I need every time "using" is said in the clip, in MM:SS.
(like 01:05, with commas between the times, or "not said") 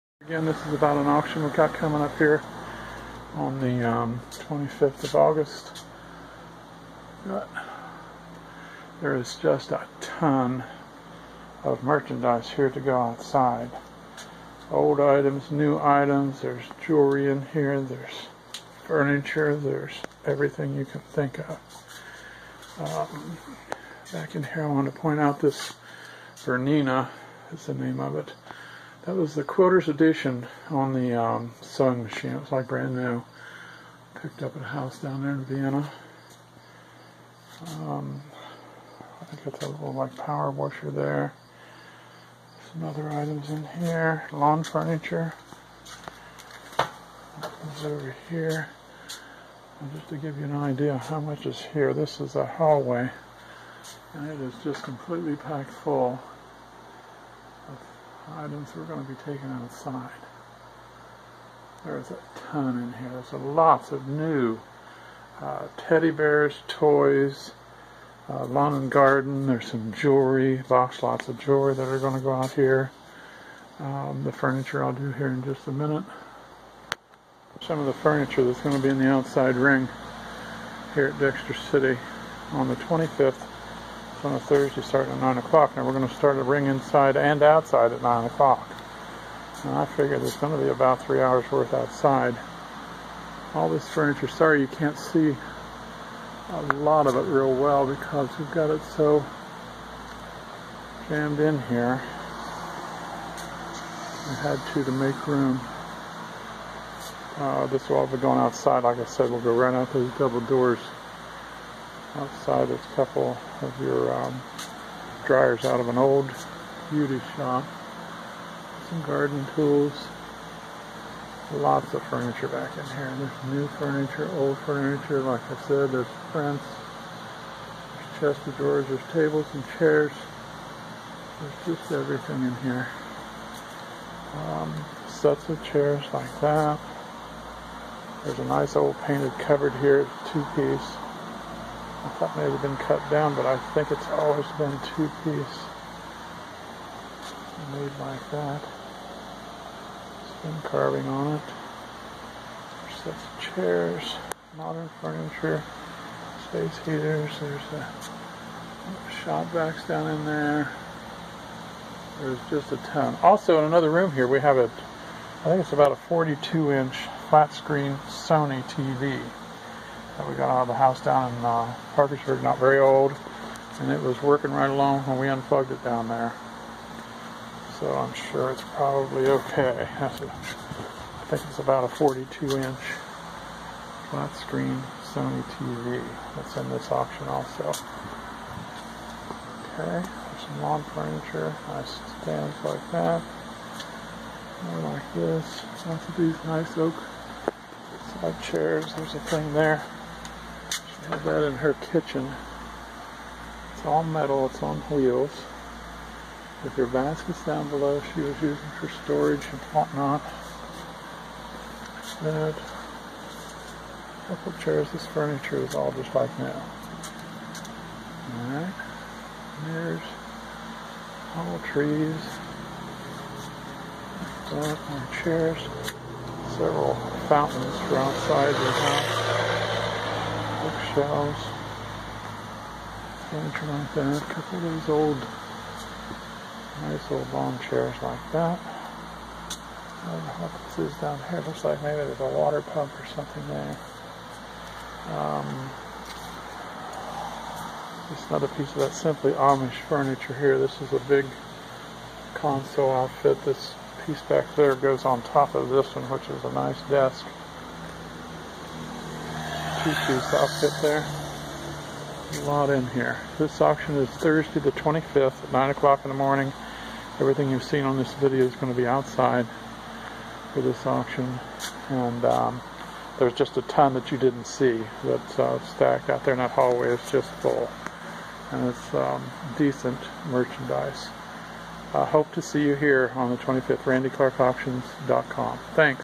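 03:28.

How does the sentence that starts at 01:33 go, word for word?
All this furniture, sorry you can't see a lot of it real well because we've got it so jammed in here.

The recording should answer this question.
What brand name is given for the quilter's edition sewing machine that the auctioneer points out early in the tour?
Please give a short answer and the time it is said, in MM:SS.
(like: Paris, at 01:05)
Bernina, at 00:26.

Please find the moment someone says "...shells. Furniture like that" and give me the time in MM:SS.
03:50.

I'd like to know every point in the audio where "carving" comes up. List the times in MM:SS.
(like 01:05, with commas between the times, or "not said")
02:30.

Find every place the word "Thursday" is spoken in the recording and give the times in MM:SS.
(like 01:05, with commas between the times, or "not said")
01:24, 04:24.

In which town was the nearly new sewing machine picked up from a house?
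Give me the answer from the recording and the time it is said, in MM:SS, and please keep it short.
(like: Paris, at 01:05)
Vienna, at 00:35.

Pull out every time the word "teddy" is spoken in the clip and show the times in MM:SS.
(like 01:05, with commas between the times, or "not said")
01:05.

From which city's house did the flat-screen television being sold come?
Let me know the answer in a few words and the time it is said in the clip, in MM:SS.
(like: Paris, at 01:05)
Parkersburg, at 02:51.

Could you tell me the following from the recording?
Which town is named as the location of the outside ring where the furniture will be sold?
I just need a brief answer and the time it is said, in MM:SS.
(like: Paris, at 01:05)
Dexter City, at 01:21.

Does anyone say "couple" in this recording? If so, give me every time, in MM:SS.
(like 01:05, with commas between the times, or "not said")
01:52, 03:34, 03:54.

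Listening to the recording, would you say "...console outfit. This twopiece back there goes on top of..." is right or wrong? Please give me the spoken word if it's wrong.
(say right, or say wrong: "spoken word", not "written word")
wrong: "piece", not "twopiece".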